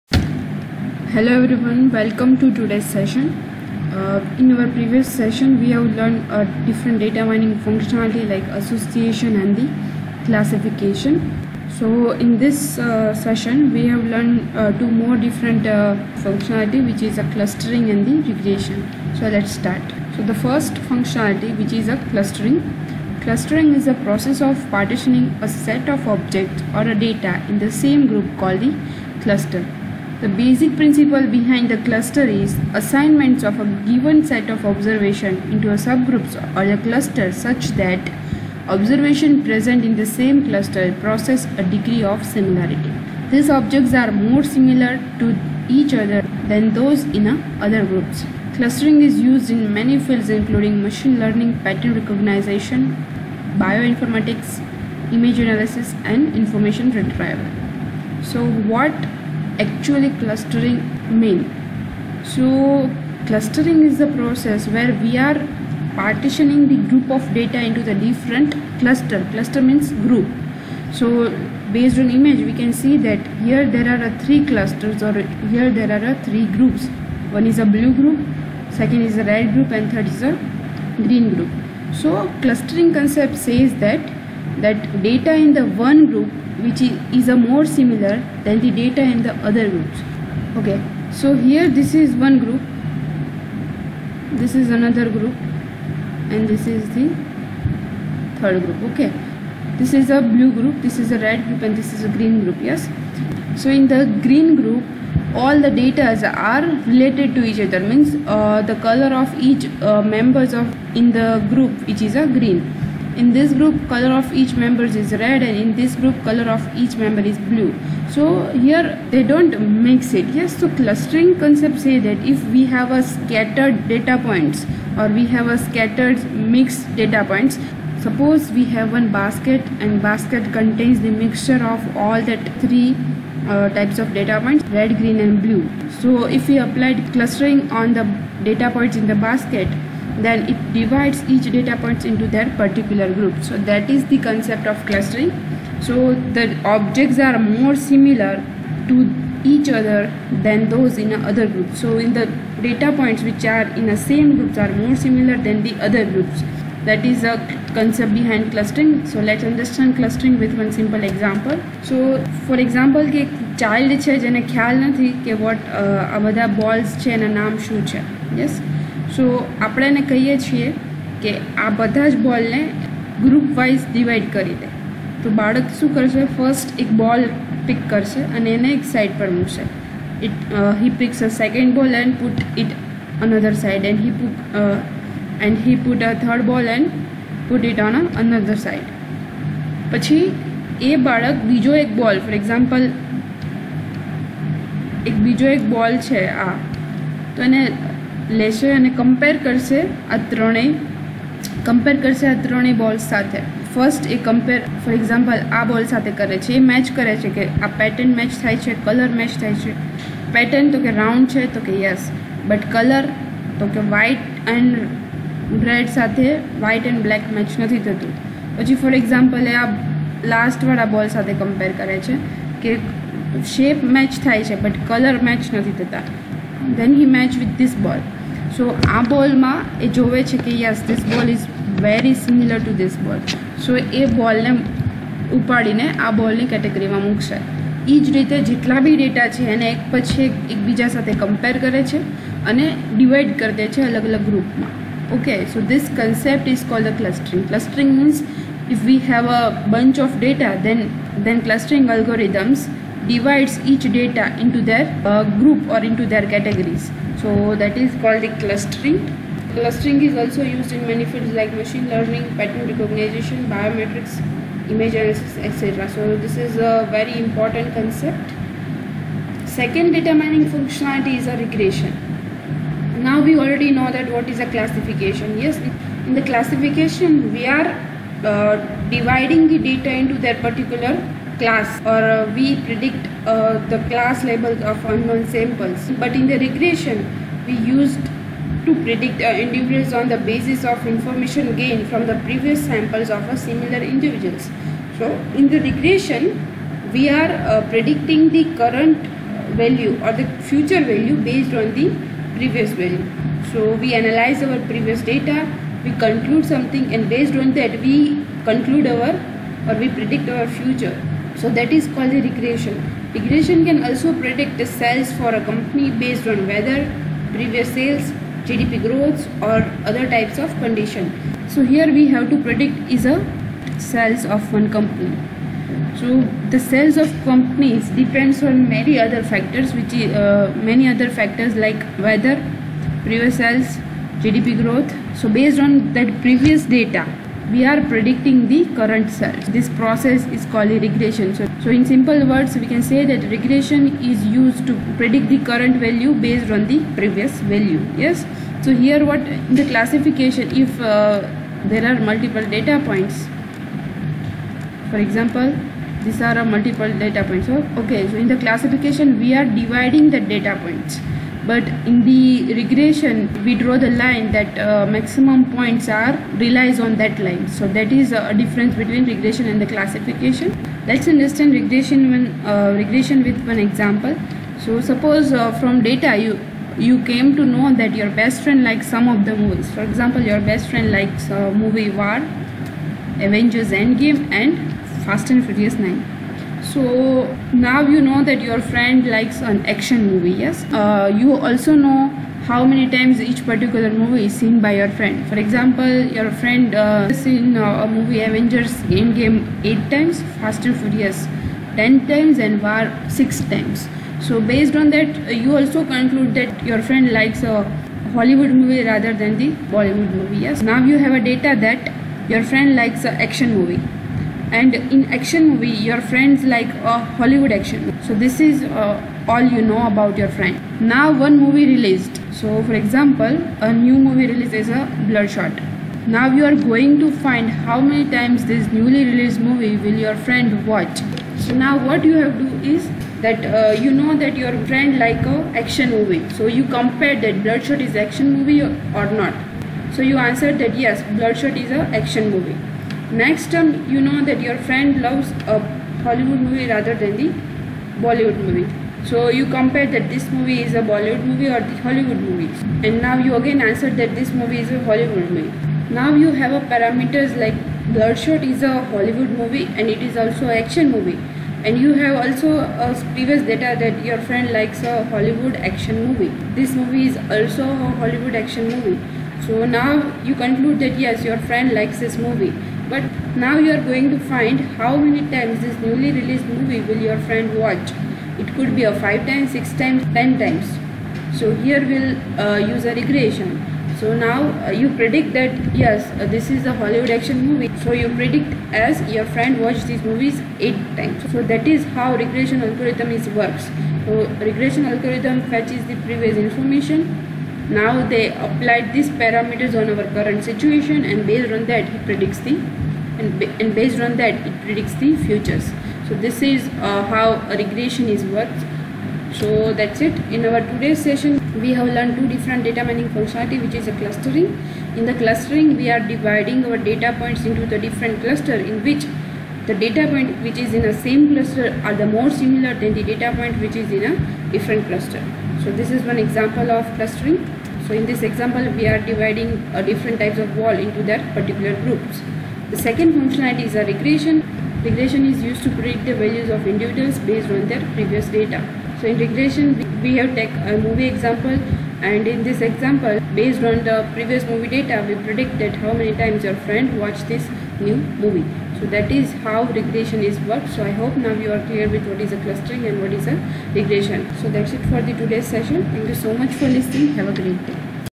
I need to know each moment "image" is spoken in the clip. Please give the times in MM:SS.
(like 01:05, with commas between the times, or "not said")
00:55, 01:12, 04:24.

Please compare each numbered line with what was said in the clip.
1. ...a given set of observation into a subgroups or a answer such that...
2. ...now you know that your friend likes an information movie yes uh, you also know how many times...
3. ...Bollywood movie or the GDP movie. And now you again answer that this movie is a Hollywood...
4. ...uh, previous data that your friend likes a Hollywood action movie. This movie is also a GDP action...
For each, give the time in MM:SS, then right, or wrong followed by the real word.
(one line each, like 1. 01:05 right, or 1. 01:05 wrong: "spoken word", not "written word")
1. 00:33 wrong: "cluster", not "answer"
2. 06:27 wrong: "action", not "information"
3. 07:30 wrong: "Hollywood", not "GDP"
4. 07:42 wrong: "Hollywood", not "GDP".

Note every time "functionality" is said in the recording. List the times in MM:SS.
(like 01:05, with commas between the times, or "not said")
00:07, 00:16, 00:20, 04:30, 08:33, 08:53.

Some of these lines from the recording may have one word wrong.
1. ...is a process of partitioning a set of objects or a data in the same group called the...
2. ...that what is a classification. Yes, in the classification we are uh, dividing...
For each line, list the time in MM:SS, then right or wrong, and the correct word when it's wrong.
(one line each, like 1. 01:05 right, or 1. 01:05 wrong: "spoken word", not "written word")
1. 00:23 right
2. 04:33 right.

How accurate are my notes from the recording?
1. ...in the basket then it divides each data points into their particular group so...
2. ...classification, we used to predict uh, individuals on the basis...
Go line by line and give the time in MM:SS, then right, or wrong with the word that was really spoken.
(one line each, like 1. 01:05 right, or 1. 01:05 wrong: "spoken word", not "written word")
1. 02:19 right
2. 04:46 wrong: "regression", not "classification".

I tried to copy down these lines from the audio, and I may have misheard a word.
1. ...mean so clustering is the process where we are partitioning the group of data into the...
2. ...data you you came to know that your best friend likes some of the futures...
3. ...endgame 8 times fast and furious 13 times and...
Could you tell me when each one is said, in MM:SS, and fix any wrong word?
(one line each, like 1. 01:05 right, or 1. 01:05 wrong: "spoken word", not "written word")
1. 01:01 right
2. 06:15 wrong: "movies", not "futures"
3. 06:38 wrong: "10", not "13".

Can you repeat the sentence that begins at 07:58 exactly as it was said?
It could be a 5 times, 6 times, 10 times.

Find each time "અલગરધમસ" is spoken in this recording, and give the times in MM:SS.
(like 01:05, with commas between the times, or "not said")
04:11.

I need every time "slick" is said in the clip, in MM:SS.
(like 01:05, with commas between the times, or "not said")
not said.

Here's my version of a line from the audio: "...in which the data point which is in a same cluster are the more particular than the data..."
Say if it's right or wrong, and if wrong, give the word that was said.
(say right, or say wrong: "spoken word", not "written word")
wrong: "similar", not "particular".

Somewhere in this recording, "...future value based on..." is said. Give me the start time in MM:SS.
05:00.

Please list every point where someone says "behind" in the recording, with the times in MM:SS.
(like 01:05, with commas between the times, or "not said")
00:31, 02:38.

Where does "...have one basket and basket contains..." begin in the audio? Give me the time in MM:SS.
02:08.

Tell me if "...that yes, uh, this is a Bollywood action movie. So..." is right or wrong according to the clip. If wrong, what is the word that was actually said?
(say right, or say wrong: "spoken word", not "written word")
wrong: "Hollywood", not "Bollywood".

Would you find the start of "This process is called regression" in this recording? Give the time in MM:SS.
05:39.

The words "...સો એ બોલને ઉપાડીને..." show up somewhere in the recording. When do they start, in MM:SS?
03:53.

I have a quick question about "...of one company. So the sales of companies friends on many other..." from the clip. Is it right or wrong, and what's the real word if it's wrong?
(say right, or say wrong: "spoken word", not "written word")
wrong: "depends", not "friends".